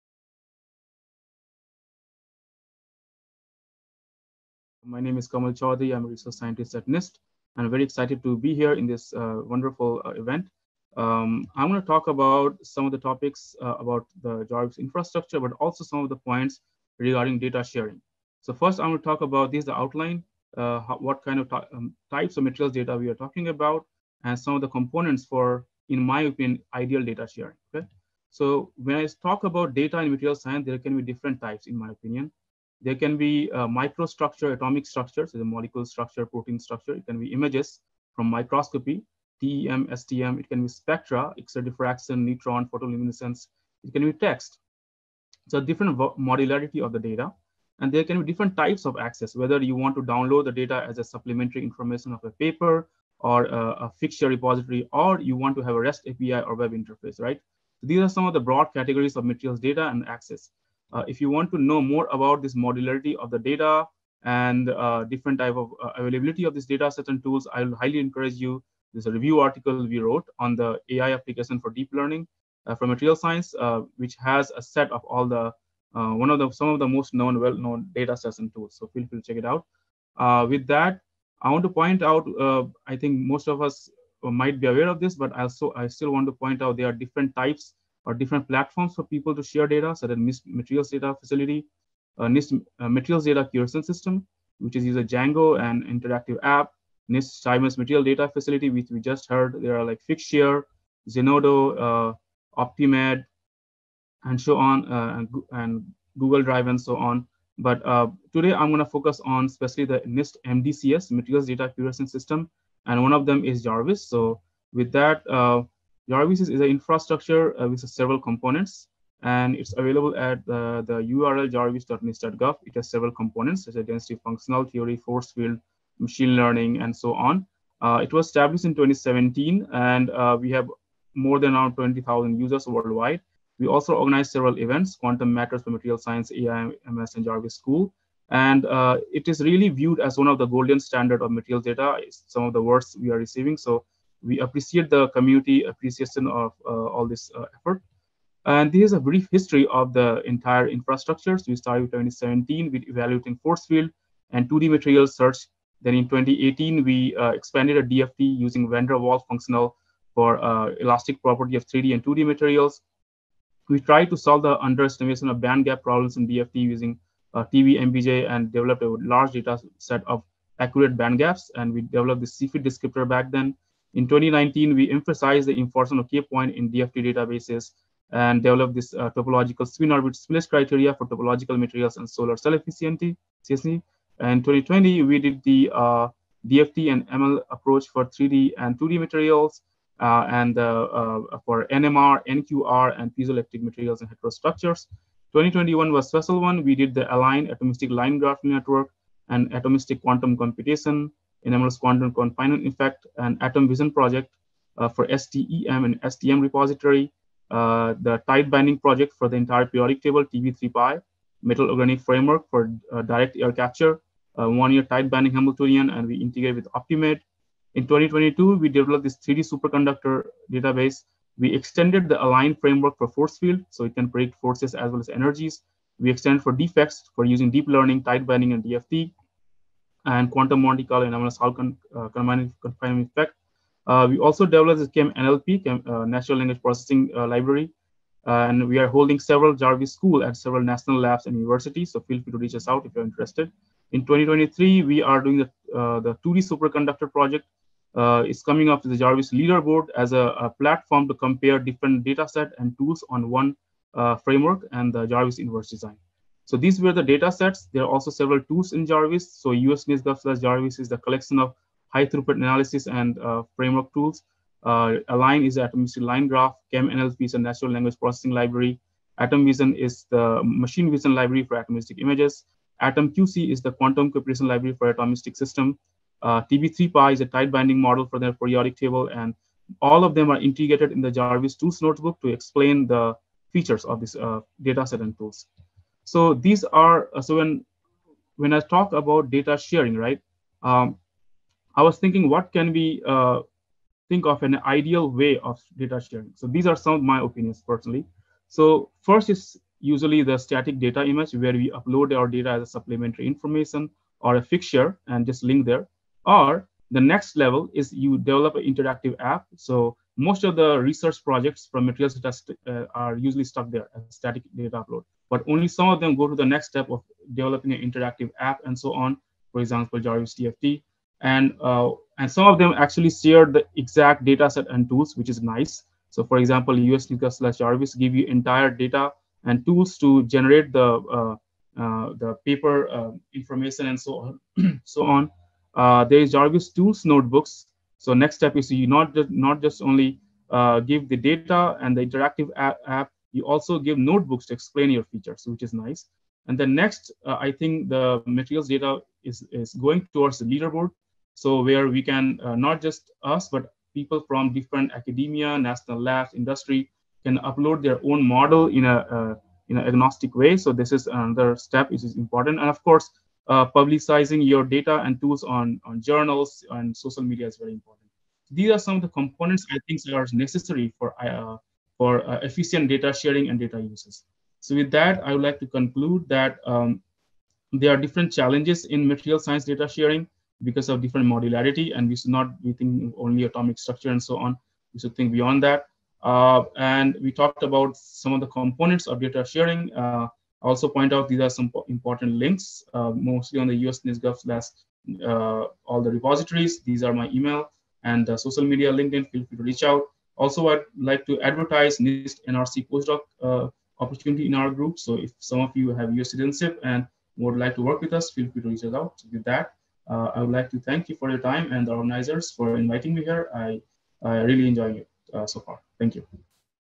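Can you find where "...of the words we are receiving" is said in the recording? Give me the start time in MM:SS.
02:22.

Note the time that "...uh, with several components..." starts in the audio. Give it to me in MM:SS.
01:57.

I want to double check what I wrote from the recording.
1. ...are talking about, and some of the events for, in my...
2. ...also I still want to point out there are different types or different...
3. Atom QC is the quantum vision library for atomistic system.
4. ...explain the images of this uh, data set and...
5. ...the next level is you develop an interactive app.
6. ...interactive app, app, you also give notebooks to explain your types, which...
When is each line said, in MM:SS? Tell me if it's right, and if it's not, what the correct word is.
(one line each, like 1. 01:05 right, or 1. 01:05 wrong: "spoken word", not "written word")
1. 00:23 wrong: "components", not "events"
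2. 01:25 right
3. 04:32 wrong: "computation", not "vision"
4. 04:42 wrong: "features", not "images"
5. 05:06 right
6. 05:42 wrong: "features", not "types".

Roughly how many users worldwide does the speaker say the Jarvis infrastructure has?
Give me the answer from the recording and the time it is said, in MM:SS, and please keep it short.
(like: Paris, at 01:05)
20,000, at 02:11.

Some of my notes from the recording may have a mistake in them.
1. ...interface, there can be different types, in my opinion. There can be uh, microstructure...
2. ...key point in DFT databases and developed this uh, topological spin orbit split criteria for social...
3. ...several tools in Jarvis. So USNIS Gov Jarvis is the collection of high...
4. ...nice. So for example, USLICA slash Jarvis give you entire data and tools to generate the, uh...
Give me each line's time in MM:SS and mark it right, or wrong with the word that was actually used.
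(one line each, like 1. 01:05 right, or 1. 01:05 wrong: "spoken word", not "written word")
1. 00:30 wrong: "science", not "interface"
2. 02:56 wrong: "topological", not "social"
3. 04:18 right
4. 05:25 right.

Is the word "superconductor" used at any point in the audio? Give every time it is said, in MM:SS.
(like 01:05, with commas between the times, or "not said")
03:39, 04:06.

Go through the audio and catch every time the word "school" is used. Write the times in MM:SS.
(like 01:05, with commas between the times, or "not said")
02:17, 03:59.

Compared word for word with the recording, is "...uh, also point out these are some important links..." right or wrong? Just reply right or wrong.
right.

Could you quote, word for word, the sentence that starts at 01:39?
There are like Figshare, Zenodo, uh, OPTIMADE, and so on, uh, and, and, Google Drive and so on.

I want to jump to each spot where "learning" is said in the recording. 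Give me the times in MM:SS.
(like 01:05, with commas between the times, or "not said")
01:11, 02:06, 03:47.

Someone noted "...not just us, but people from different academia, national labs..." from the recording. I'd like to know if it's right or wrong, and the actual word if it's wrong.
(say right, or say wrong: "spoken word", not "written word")
right.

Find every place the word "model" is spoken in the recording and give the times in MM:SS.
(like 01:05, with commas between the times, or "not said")
04:37, 05:58.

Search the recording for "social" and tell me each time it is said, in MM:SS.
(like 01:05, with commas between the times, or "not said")
06:06, 06:38.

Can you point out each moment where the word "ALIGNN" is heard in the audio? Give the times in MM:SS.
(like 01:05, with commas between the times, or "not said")
03:17, 03:42, 04:25.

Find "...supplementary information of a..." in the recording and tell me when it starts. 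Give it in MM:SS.
00:51.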